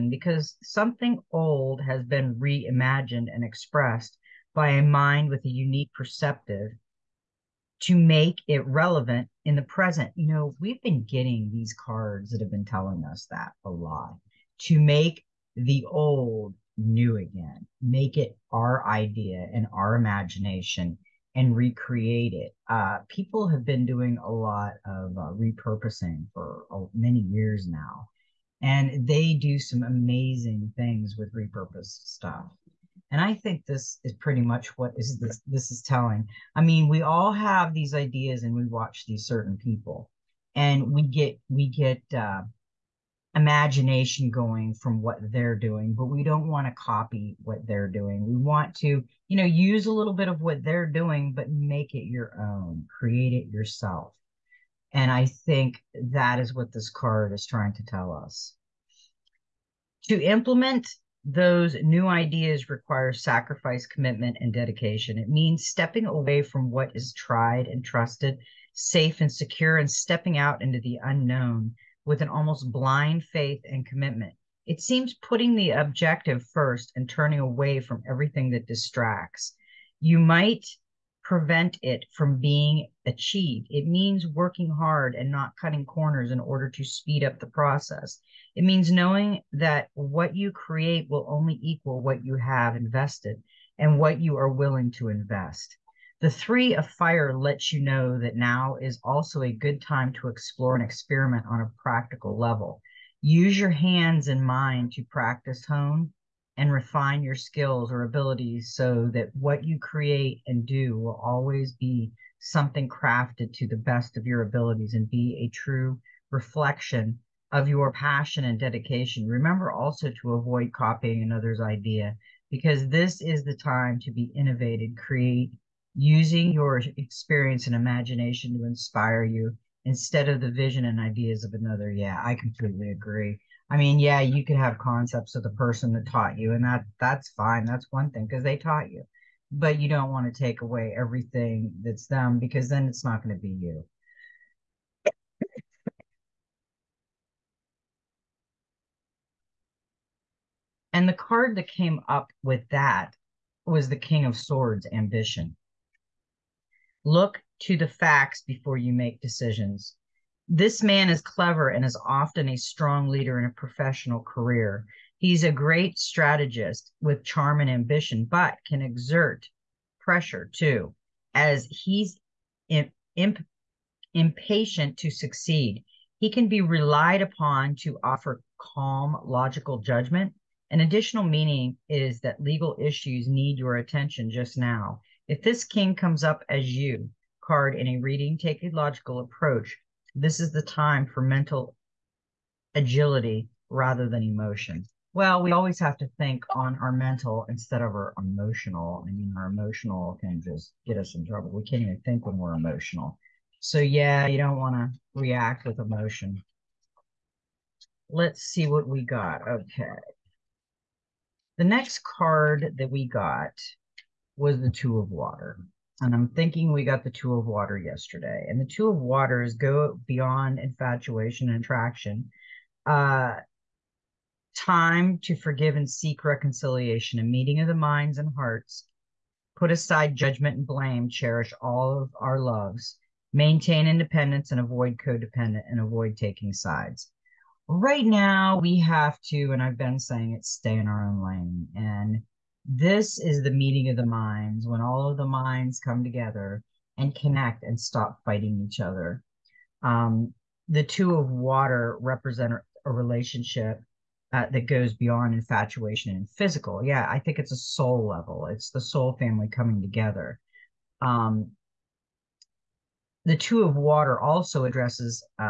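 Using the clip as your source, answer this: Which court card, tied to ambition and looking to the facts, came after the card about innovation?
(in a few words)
King of Swords.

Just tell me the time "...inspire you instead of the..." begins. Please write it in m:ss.
2:08.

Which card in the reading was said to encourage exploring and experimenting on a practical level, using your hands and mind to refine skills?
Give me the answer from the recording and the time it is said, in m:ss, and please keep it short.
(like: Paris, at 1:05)
Three of Fire, at 1:36.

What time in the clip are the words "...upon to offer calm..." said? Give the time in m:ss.
2:57.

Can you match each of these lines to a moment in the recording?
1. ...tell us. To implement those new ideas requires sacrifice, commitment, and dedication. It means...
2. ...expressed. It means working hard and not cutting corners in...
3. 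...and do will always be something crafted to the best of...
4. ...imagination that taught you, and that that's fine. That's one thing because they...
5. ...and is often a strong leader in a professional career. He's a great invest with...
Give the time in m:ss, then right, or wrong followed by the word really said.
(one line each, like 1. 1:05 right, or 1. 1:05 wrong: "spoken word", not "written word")
1. 0:57 right
2. 1:23 wrong: "achieved", not "expressed"
3. 1:50 right
4. 2:15 wrong: "person", not "imagination"
5. 2:41 wrong: "strategist", not "invest".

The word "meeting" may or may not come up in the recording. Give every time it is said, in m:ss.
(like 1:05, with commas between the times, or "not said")
3:47, 4:03.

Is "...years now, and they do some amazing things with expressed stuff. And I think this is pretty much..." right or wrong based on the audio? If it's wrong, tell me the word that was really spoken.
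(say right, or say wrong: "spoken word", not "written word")
wrong: "repurposed", not "expressed".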